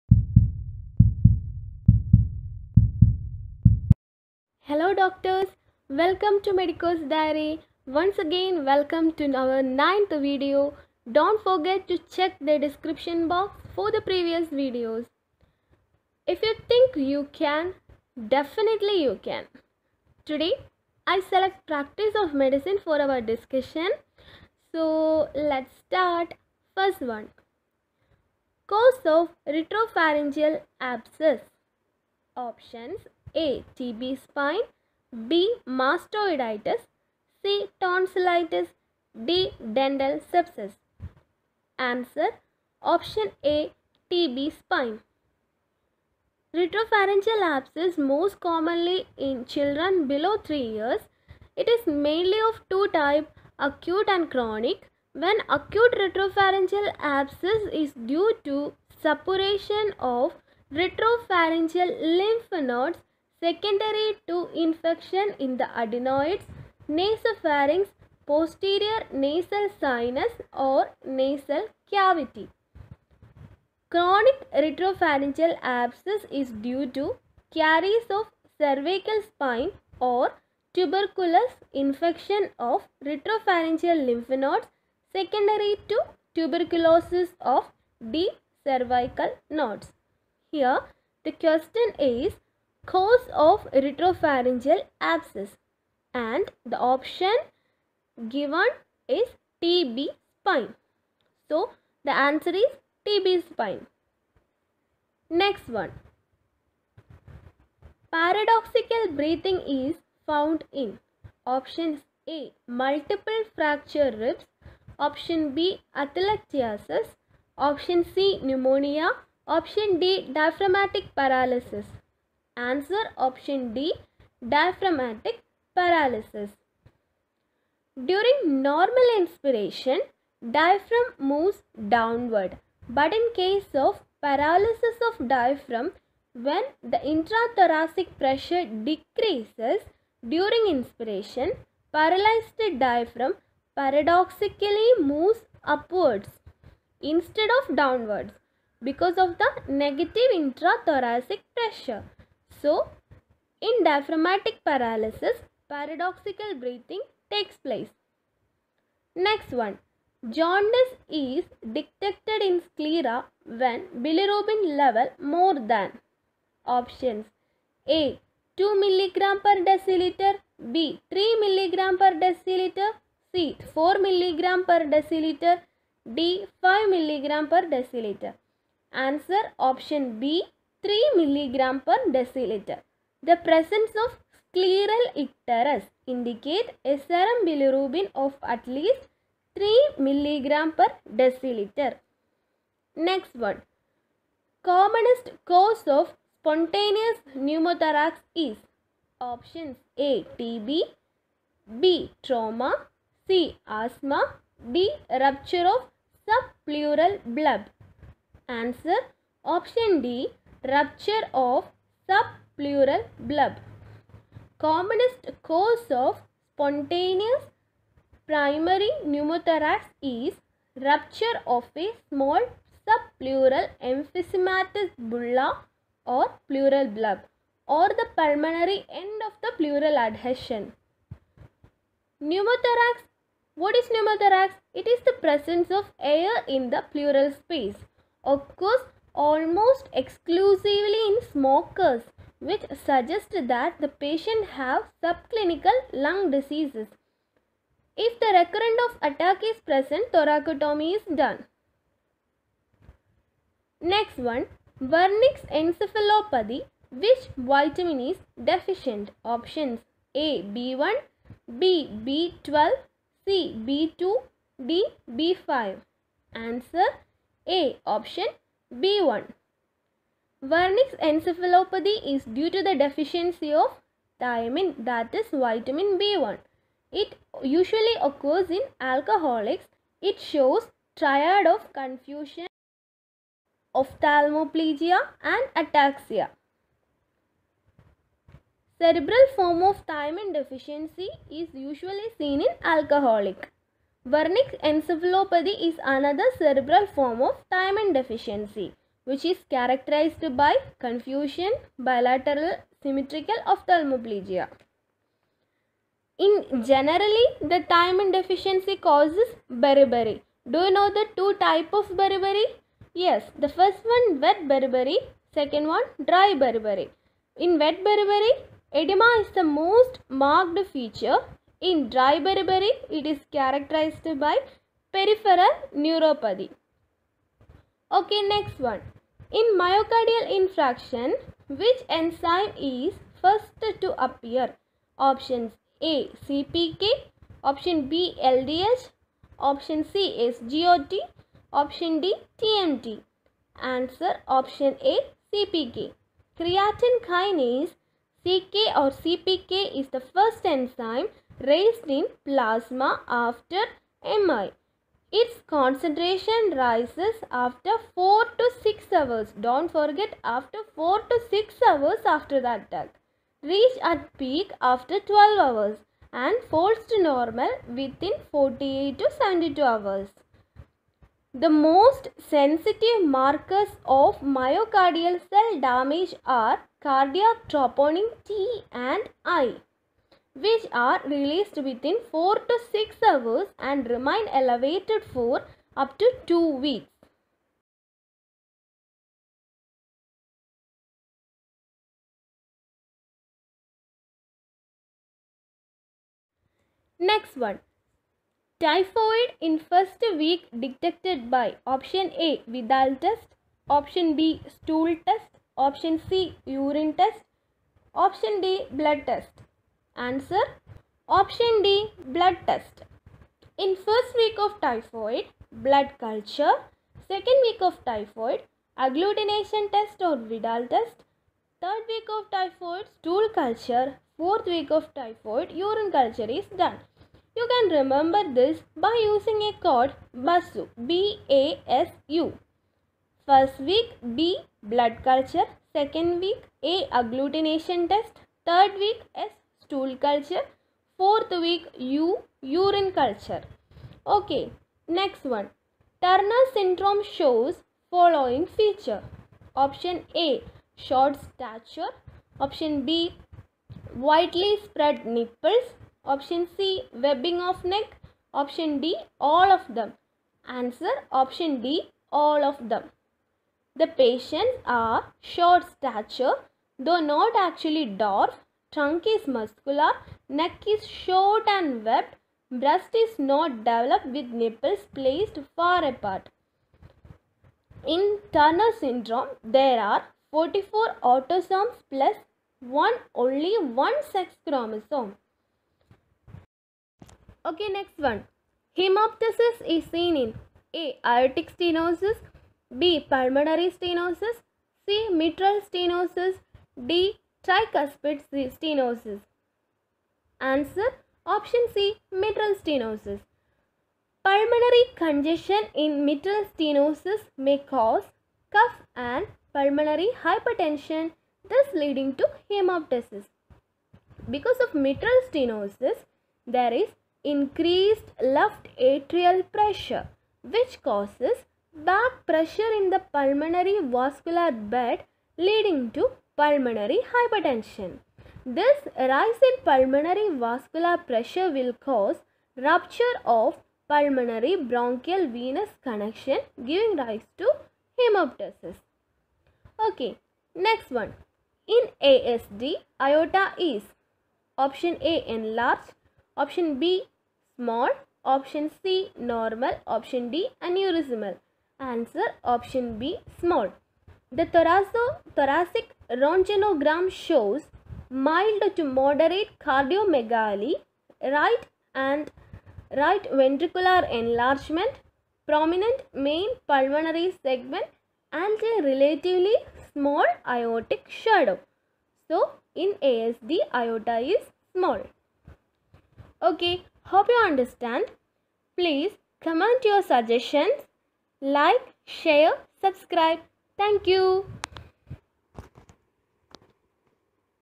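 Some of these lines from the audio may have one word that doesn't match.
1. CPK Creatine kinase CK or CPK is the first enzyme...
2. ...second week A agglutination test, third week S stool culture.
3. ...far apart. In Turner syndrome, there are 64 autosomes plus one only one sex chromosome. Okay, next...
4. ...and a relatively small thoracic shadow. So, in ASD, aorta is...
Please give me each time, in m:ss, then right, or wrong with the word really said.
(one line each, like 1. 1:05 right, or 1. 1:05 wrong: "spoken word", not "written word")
1. 5:45 right
2. 7:15 right
3. 7:55 wrong: "44", not "64"
4. 9:28 wrong: "aortic", not "thoracic".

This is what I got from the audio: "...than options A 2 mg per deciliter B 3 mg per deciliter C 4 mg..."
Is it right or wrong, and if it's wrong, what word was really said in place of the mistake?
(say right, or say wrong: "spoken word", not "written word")
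right.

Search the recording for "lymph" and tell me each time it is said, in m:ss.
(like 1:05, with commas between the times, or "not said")
1:02, 1:24.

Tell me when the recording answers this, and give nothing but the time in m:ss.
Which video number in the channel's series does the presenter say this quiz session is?
0:09.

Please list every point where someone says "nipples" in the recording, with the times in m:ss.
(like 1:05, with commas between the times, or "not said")
7:35, 7:54.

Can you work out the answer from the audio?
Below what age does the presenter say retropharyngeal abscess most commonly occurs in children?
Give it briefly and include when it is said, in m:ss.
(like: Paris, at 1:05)
3 years, at 0:50.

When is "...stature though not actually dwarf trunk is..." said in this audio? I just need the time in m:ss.
7:45.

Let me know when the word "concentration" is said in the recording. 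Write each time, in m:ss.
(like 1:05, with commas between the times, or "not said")
5:55.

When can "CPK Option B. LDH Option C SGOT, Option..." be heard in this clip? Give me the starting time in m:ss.
5:36.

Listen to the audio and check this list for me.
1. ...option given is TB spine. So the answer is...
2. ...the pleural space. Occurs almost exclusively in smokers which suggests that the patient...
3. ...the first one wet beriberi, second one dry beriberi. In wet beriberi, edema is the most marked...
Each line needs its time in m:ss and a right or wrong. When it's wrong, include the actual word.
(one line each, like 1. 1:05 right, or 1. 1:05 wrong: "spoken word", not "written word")
1. 1:36 right
2. 3:56 right
3. 5:13 right.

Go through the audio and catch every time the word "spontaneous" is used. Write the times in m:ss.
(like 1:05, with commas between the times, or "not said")
3:16, 3:36.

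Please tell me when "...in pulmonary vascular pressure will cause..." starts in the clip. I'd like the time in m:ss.
8:49.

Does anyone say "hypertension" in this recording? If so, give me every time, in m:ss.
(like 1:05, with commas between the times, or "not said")
8:30, 8:47.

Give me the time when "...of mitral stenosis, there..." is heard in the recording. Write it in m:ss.
8:34.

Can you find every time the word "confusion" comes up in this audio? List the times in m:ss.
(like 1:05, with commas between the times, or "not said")
4:41, 5:00.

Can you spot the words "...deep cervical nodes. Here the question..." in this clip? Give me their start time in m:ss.
1:28.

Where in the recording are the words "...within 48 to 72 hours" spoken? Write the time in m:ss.
6:07.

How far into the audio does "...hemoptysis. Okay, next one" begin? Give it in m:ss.
8:57.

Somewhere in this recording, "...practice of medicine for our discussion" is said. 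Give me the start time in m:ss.
0:21.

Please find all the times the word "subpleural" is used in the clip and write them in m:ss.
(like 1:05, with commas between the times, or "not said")
3:26, 3:32, 3:42.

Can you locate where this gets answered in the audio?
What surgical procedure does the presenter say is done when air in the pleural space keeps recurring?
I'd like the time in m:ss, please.
4:10.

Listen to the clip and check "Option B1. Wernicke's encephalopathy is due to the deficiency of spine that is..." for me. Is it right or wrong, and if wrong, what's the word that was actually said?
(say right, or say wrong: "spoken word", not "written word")
wrong: "thiamine", not "spine".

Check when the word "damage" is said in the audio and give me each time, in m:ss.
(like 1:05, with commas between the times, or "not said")
6:15.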